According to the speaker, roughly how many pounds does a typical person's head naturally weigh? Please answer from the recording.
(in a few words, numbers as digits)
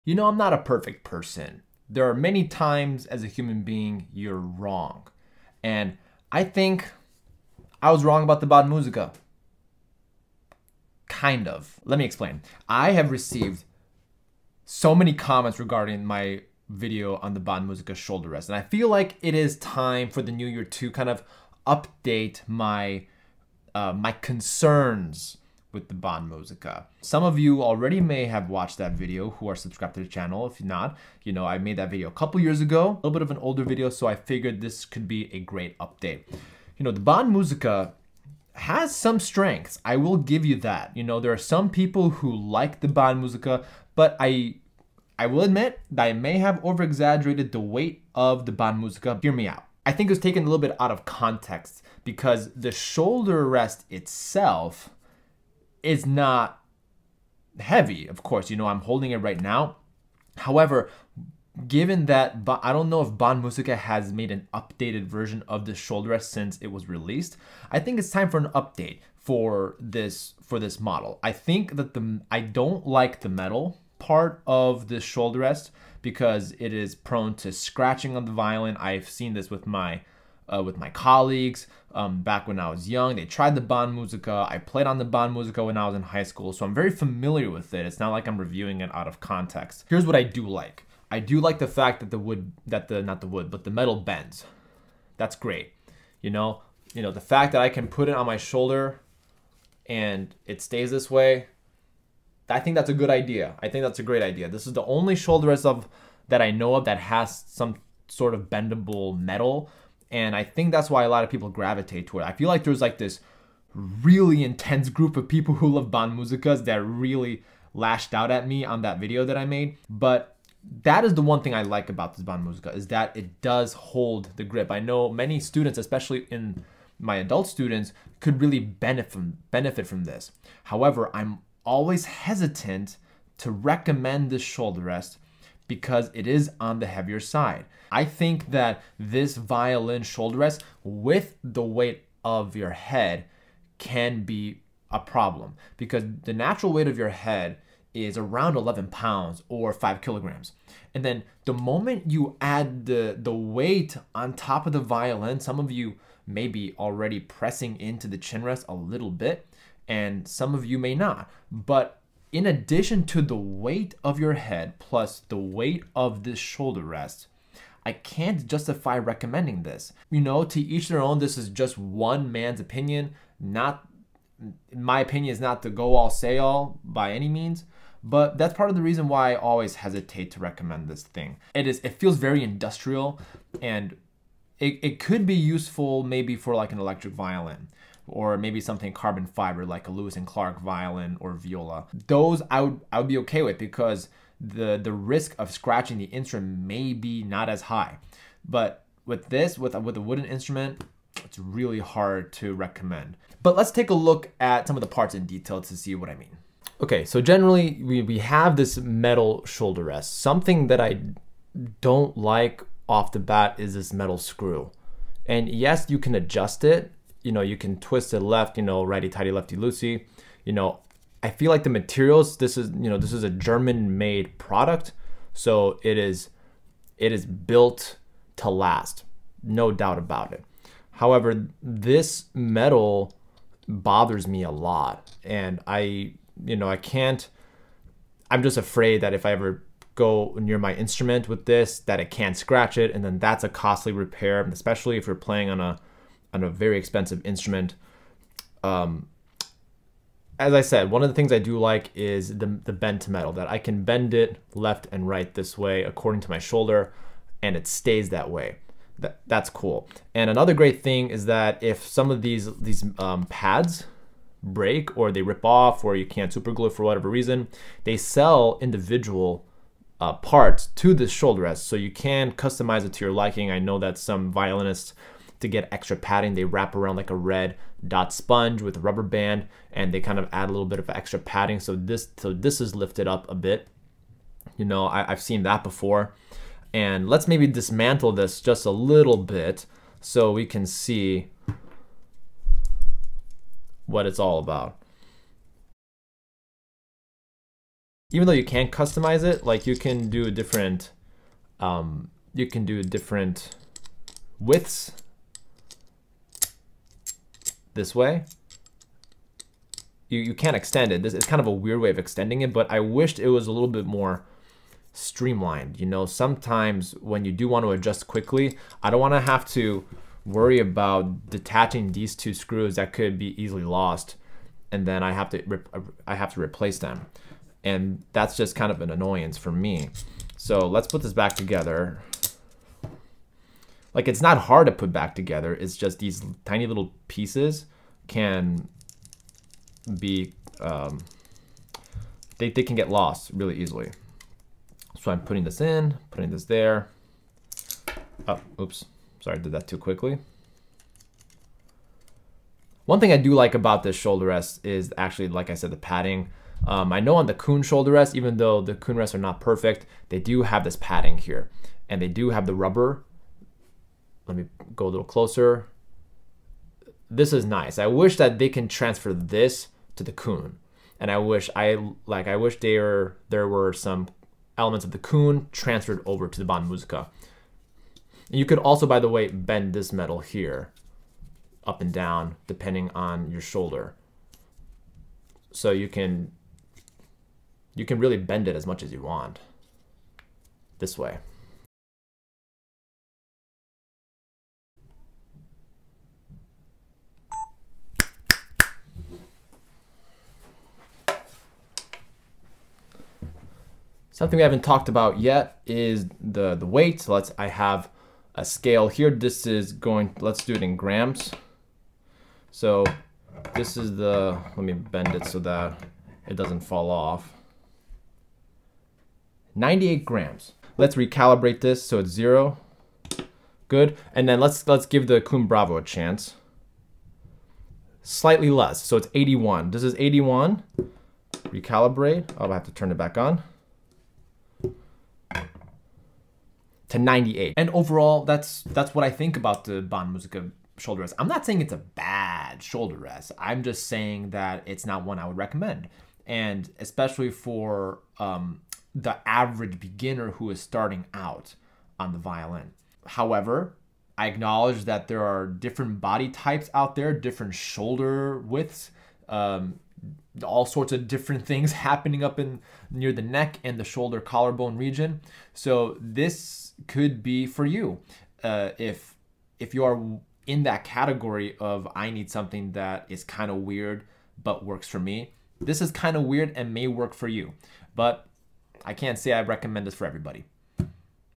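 11 pounds.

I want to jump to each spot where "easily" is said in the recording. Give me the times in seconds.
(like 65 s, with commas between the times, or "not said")
323 s, 343 s.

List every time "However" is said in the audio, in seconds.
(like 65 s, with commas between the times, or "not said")
60 s, 130 s, 230 s, 453 s.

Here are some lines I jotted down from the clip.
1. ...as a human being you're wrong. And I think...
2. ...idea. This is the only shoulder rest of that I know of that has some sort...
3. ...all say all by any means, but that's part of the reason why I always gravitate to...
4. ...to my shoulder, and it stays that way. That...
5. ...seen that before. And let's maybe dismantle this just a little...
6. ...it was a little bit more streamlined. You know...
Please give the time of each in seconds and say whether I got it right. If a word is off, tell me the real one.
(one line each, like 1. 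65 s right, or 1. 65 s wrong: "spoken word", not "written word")
1. 3 s right
2. 104 s right
3. 175 s wrong: "hesitate", not "gravitate"
4. 256 s right
5. 285 s right
6. 313 s right.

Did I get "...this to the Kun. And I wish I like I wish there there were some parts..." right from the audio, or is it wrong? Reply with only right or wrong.
wrong.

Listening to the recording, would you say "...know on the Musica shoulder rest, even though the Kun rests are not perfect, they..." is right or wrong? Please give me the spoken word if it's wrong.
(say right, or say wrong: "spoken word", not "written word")
wrong: "Kun", not "Musica".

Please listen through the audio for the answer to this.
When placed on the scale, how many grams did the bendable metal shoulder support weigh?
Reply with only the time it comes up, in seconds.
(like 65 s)
419 s.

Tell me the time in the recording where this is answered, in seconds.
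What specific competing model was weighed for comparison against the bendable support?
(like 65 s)
425 s.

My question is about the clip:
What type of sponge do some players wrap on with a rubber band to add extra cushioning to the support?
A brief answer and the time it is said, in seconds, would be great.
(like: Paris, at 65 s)
red dot sponge, at 277 s.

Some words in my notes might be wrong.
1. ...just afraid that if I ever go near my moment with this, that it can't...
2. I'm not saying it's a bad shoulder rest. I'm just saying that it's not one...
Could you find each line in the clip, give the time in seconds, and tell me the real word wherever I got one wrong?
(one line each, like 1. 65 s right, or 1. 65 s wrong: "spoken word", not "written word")
1. 238 s wrong: "instrument", not "moment"
2. 441 s right.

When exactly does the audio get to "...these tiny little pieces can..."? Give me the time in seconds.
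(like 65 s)
335 s.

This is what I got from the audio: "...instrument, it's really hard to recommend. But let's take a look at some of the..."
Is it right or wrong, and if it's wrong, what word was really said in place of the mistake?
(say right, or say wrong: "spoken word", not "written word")
right.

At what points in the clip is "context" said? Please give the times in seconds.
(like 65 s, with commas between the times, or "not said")
51 s, 89 s.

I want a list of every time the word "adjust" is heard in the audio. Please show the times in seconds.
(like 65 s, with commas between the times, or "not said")
216 s, 317 s.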